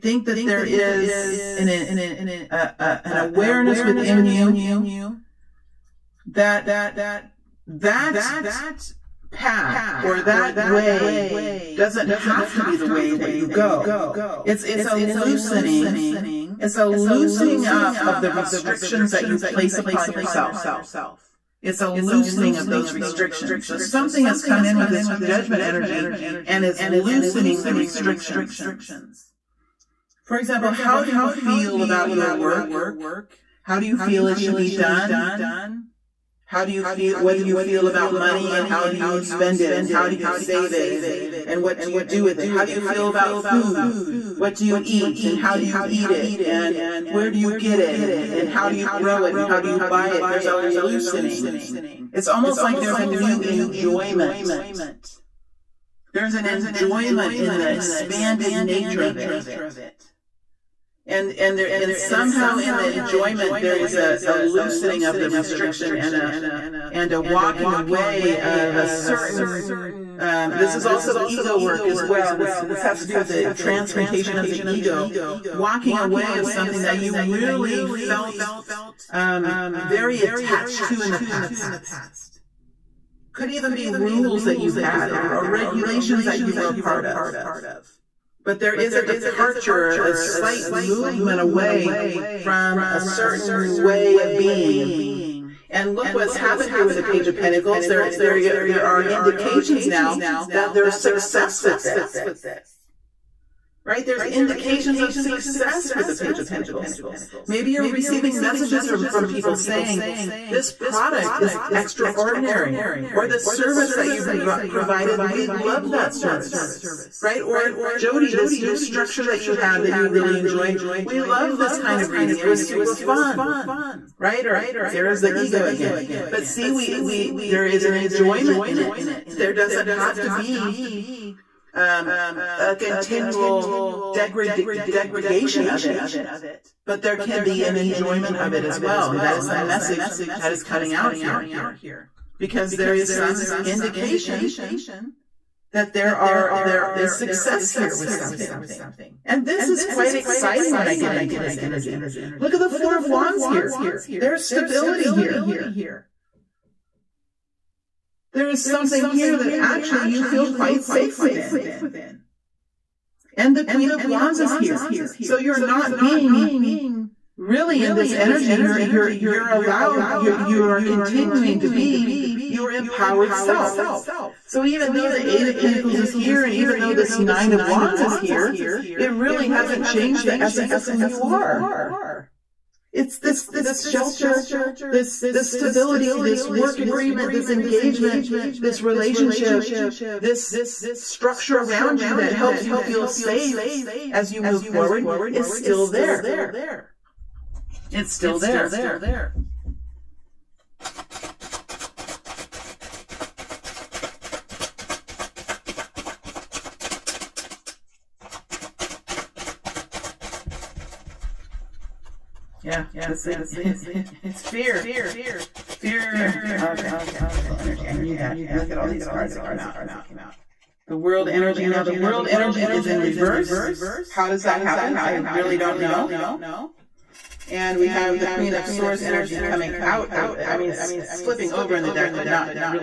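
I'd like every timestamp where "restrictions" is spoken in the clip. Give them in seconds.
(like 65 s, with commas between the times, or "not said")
18 s, 22 s, 27 s, 65 s.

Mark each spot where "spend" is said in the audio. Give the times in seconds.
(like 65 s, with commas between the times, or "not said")
39 s.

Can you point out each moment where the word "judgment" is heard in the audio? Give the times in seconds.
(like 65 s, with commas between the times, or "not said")
25 s.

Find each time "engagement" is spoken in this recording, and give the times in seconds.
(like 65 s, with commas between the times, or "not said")
187 s.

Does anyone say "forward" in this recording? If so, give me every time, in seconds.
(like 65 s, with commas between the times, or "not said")
194 s.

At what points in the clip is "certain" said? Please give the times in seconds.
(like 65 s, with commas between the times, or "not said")
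68 s, 93 s.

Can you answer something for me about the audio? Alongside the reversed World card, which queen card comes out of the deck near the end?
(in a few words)
Queen of Swords.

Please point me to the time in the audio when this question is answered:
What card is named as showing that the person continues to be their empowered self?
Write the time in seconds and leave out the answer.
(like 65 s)
163 s.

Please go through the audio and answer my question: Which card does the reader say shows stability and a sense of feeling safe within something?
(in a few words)
Four of Wands.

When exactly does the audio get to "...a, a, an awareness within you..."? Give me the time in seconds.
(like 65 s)
1 s.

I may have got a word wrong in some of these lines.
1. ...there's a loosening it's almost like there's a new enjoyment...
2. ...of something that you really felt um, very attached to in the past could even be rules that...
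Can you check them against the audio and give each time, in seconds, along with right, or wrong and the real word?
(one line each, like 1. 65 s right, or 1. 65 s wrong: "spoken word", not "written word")
1. 50 s right
2. 76 s right.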